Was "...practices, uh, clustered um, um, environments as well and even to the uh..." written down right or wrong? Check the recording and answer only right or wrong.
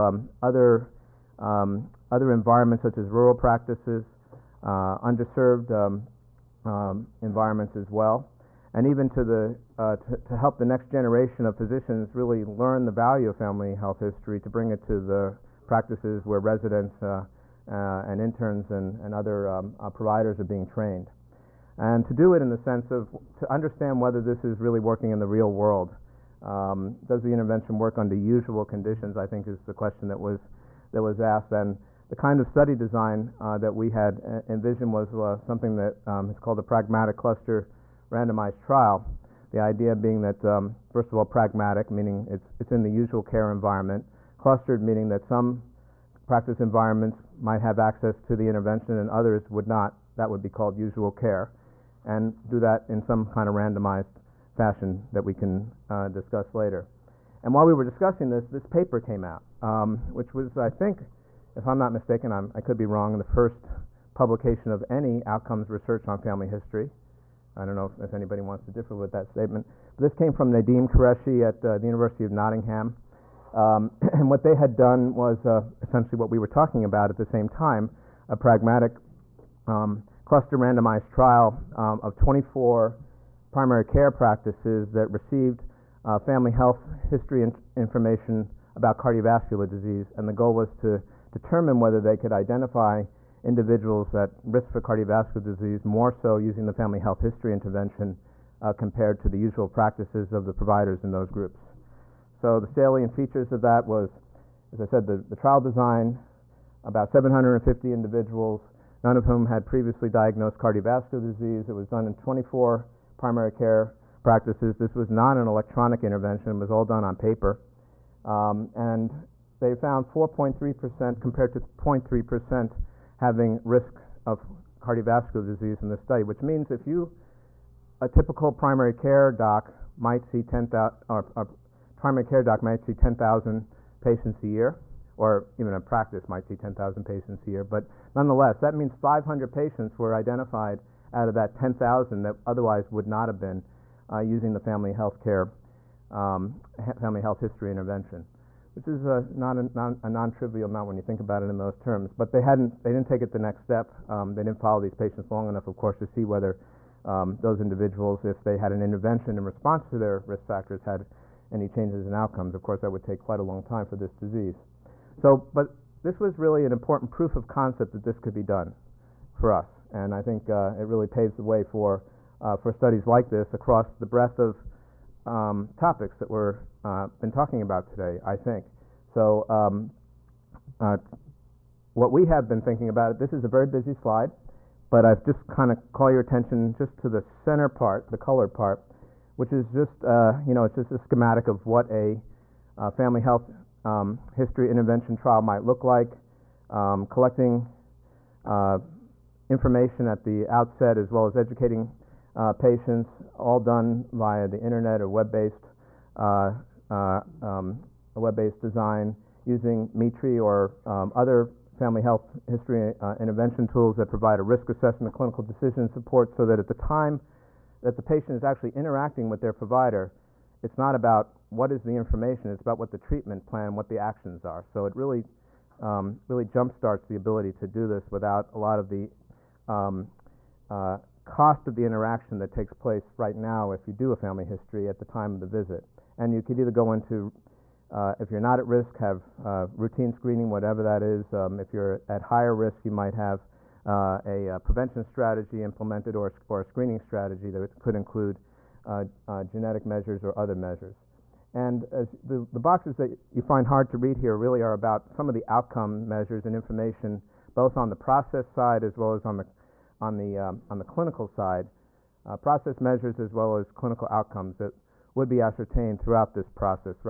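wrong.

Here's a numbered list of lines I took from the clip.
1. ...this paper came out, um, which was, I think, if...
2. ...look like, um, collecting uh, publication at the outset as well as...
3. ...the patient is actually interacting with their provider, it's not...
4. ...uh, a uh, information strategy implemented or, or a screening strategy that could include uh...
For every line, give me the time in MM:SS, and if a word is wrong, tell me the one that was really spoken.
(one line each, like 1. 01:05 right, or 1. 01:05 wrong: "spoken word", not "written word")
1. 00:58 right
2. 03:15 wrong: "information", not "publication"
3. 03:37 right
4. 04:03 wrong: "prevention", not "information".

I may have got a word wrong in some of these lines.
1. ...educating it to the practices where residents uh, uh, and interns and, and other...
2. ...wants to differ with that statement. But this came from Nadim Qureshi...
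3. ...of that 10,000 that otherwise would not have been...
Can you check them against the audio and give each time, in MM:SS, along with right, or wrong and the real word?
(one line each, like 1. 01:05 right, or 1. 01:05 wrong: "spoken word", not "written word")
1. 00:14 wrong: "bring", not "educating"
2. 01:08 right
3. 02:21 right.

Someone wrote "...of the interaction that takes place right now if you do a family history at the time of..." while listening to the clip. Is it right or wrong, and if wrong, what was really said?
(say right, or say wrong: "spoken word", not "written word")
right.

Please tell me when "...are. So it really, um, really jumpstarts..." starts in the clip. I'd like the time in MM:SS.
03:44.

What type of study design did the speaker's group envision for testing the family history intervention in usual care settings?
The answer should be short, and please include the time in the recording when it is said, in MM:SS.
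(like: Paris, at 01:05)
pragmatic cluster randomized trial, at 00:36.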